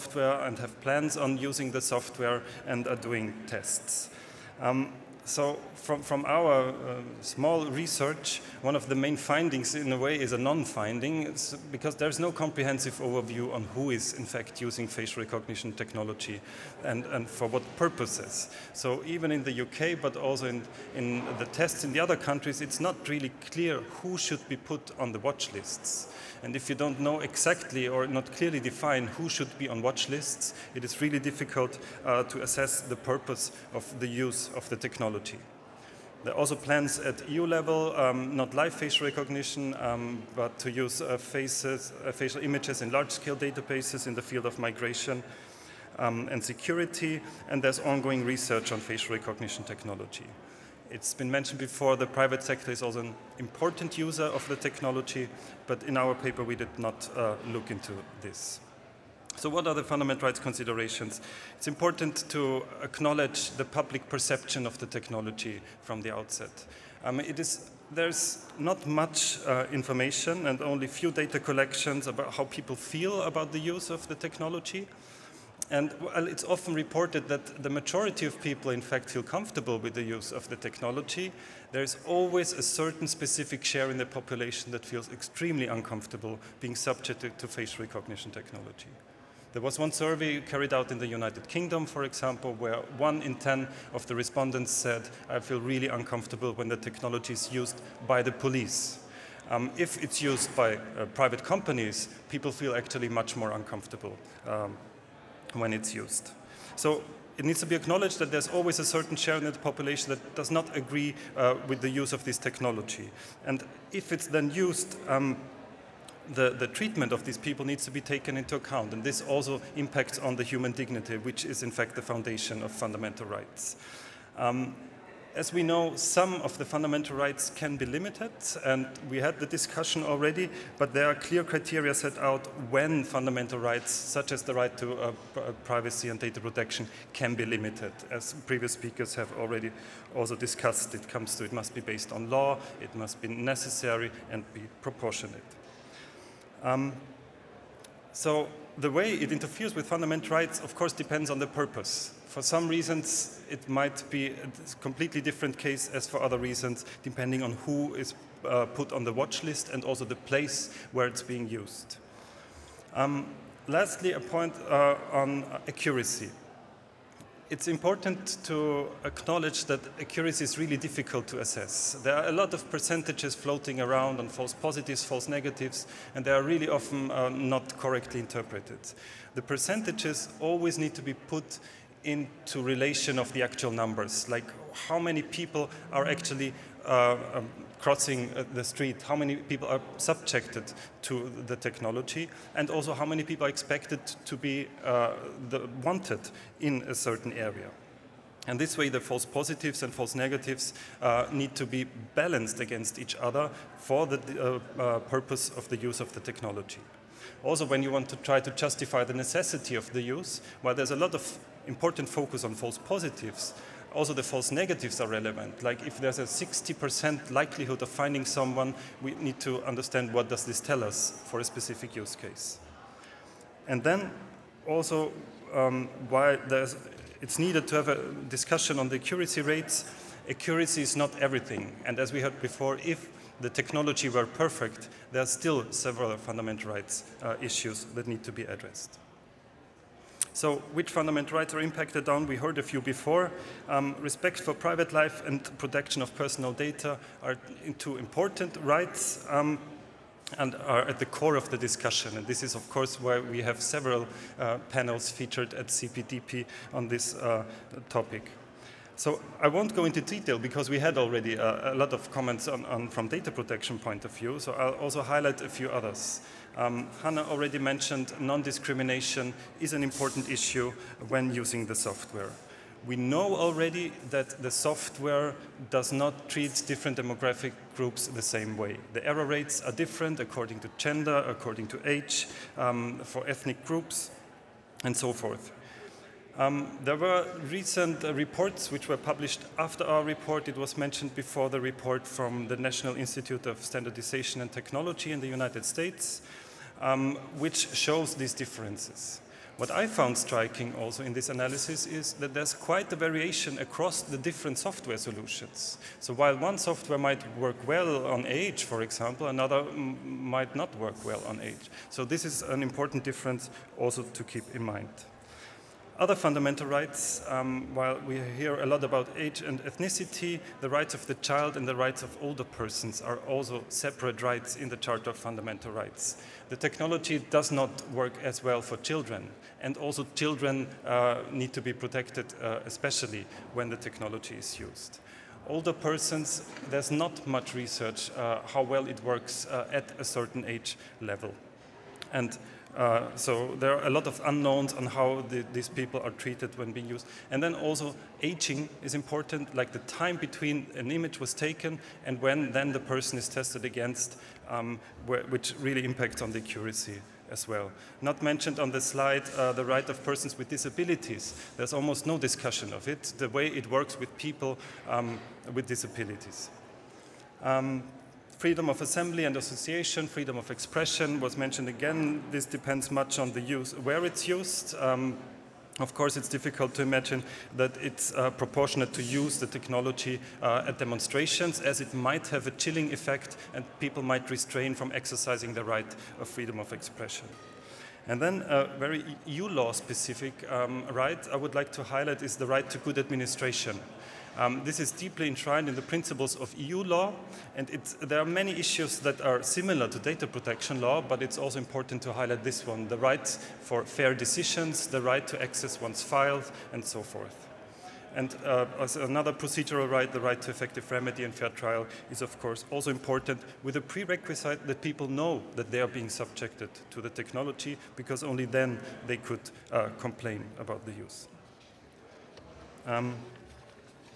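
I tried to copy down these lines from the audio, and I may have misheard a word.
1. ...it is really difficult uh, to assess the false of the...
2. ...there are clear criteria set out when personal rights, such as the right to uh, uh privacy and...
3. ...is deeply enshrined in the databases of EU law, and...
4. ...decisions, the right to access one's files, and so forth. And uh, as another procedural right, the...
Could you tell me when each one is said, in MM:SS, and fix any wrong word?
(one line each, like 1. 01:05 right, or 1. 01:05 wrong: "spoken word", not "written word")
1. 00:30 wrong: "purpose", not "false"
2. 02:10 wrong: "fundamental", not "personal"
3. 06:34 wrong: "principles", not "databases"
4. 06:44 right.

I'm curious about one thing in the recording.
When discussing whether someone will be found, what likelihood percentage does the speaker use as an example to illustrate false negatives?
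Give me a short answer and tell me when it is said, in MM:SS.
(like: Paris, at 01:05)
60%, at 03:36.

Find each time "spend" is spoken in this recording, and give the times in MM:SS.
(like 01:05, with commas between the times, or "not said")
not said.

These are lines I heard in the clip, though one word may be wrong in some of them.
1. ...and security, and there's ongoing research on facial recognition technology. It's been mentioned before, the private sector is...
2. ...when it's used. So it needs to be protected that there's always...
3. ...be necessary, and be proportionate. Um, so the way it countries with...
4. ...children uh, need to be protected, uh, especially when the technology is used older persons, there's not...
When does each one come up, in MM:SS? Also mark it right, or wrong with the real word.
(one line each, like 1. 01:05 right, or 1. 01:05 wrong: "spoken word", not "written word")
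1. 00:46 right
2. 01:45 wrong: "acknowledged", not "protected"
3. 02:23 wrong: "interferes", not "countries"
4. 05:30 right.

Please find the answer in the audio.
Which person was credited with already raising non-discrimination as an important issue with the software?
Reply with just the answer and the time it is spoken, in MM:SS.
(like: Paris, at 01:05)
Hannah, at 04:27.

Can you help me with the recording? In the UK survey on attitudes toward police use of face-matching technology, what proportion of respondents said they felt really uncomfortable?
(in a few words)
1 in 10.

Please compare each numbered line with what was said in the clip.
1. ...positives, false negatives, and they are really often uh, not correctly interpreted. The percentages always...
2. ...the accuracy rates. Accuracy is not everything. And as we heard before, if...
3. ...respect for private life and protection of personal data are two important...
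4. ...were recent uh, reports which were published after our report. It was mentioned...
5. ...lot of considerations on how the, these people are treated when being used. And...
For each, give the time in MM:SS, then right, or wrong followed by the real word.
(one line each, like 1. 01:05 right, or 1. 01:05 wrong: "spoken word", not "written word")
1. 02:54 right
2. 03:48 right
3. 04:03 right
4. 04:46 right
5. 05:43 wrong: "unknowns", not "considerations".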